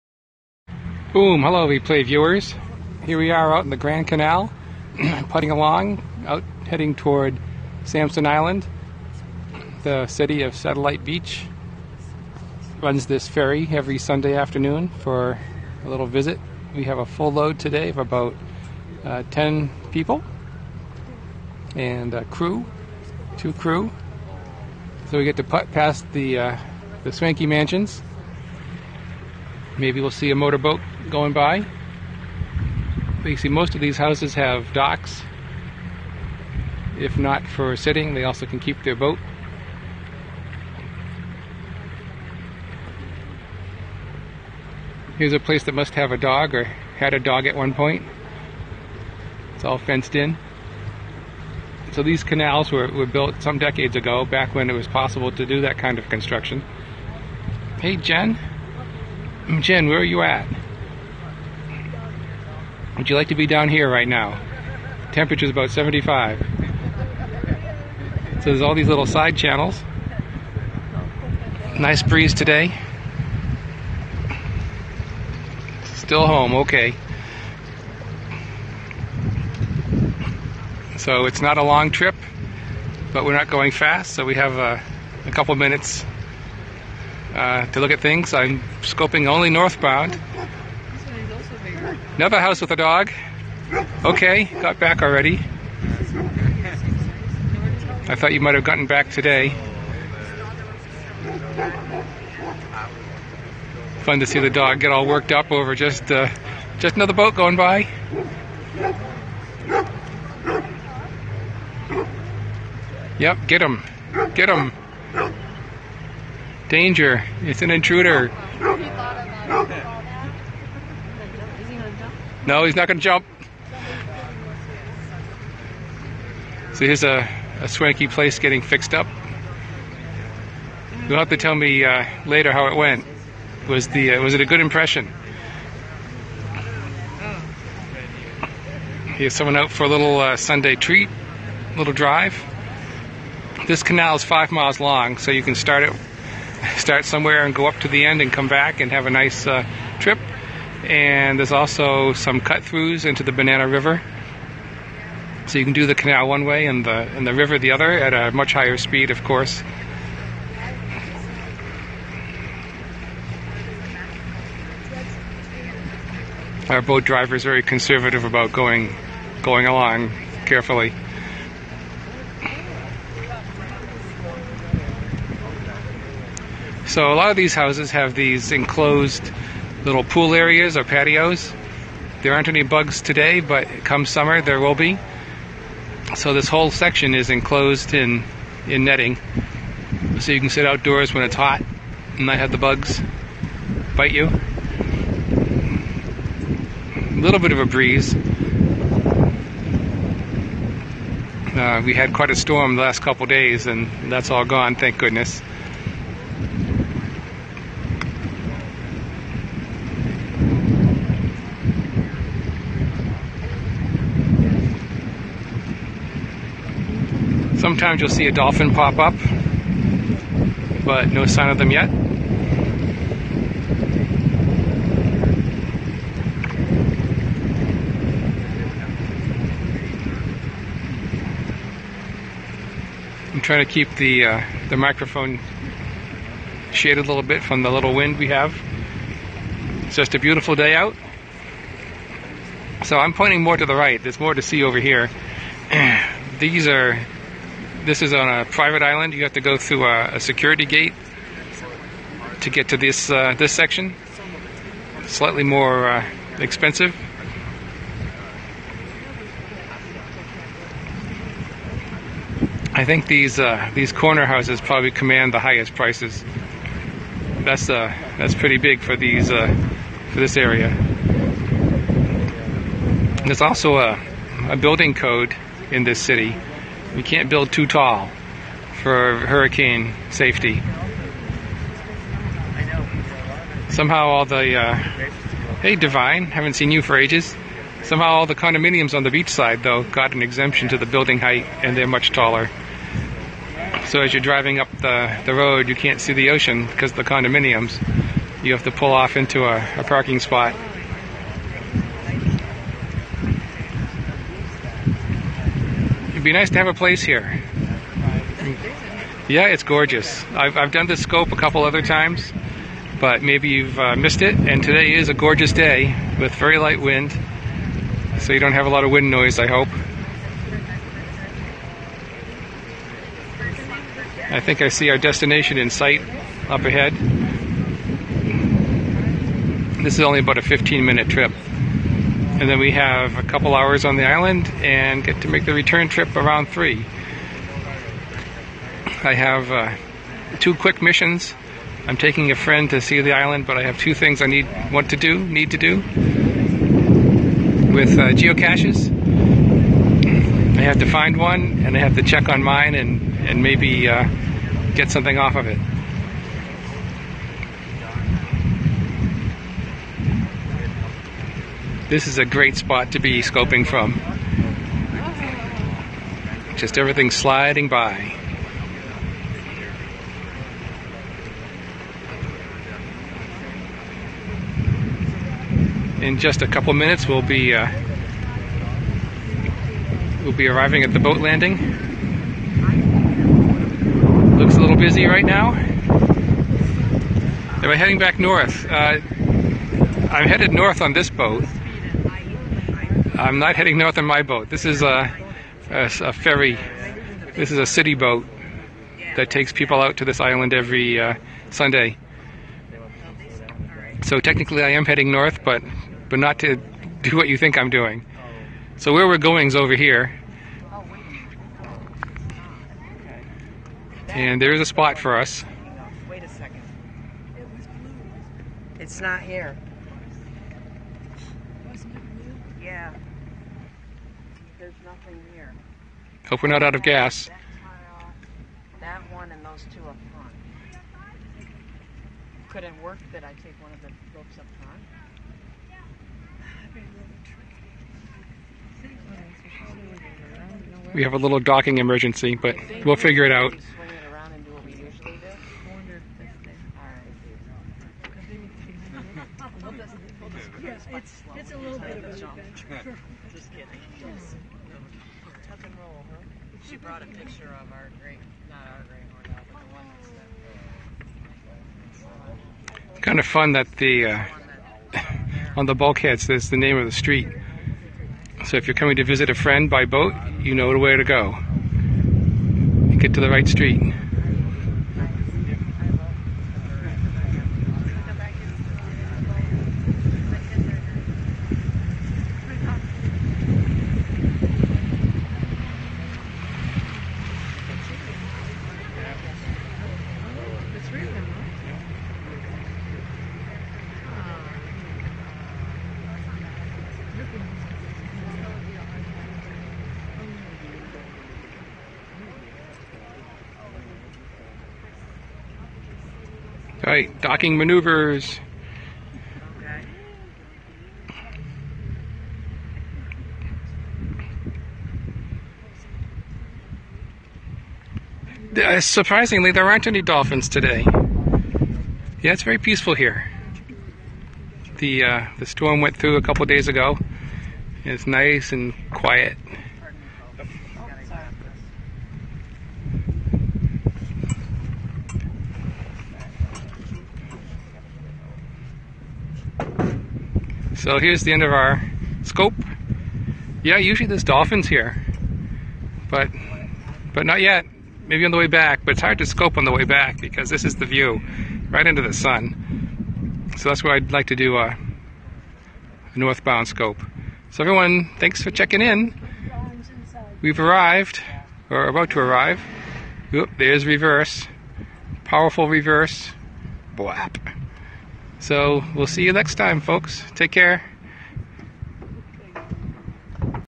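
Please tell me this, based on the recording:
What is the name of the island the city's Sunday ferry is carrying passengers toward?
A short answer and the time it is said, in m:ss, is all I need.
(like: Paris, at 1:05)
Samson Island, at 0:07.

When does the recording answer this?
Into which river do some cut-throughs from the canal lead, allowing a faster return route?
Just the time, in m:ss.
2:33.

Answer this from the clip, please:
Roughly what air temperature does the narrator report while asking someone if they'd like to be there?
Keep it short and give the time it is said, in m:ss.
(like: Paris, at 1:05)
75, at 1:05.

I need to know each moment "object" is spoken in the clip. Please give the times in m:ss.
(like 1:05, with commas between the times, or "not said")
not said.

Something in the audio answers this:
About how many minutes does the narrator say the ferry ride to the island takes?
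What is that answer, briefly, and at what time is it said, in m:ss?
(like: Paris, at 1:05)
15, at 5:30.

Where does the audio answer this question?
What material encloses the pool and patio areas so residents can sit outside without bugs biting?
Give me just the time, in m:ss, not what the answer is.
3:08.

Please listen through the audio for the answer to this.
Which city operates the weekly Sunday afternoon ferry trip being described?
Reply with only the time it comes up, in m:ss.
0:10.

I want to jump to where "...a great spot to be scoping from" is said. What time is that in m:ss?
6:02.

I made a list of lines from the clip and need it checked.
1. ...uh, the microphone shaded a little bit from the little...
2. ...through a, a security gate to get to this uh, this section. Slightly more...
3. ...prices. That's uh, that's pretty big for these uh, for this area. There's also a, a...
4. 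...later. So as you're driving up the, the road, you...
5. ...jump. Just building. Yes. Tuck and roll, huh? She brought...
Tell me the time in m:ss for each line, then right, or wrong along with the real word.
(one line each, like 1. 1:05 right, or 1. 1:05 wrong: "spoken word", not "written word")
1. 3:54 right
2. 4:09 right
3. 4:25 right
4. 4:52 wrong: "taller", not "later"
5. 7:32 wrong: "kidding", not "building".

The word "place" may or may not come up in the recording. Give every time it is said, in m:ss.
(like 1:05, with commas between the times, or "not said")
0:45, 2:08, 5:06.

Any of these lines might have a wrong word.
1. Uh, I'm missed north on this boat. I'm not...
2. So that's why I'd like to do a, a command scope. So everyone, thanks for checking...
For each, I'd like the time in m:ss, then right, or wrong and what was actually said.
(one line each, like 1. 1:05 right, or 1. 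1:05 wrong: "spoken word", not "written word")
1. 6:28 wrong: "headed", not "missed"
2. 9:13 wrong: "northbound", not "command".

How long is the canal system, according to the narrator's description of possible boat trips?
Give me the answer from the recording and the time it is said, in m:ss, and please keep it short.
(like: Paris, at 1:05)
5 miles, at 2:24.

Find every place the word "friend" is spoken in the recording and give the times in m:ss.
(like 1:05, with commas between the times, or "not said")
5:42, 7:49.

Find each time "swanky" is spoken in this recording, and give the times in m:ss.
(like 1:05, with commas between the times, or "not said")
0:27, 2:07.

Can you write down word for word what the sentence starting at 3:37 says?
Sometimes you'll see a dolphin pop up, but no sign of them yet.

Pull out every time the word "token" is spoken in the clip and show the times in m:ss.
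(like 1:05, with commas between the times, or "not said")
not said.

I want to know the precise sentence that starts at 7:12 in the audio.
Could it work that I take one of the ropes up front?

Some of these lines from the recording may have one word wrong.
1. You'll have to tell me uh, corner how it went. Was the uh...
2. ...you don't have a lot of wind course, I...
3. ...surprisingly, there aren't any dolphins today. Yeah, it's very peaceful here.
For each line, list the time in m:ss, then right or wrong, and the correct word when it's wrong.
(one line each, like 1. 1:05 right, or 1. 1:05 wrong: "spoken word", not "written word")
1. 2:11 wrong: "later", not "corner"
2. 5:18 wrong: "noise", not "course"
3. 8:38 right.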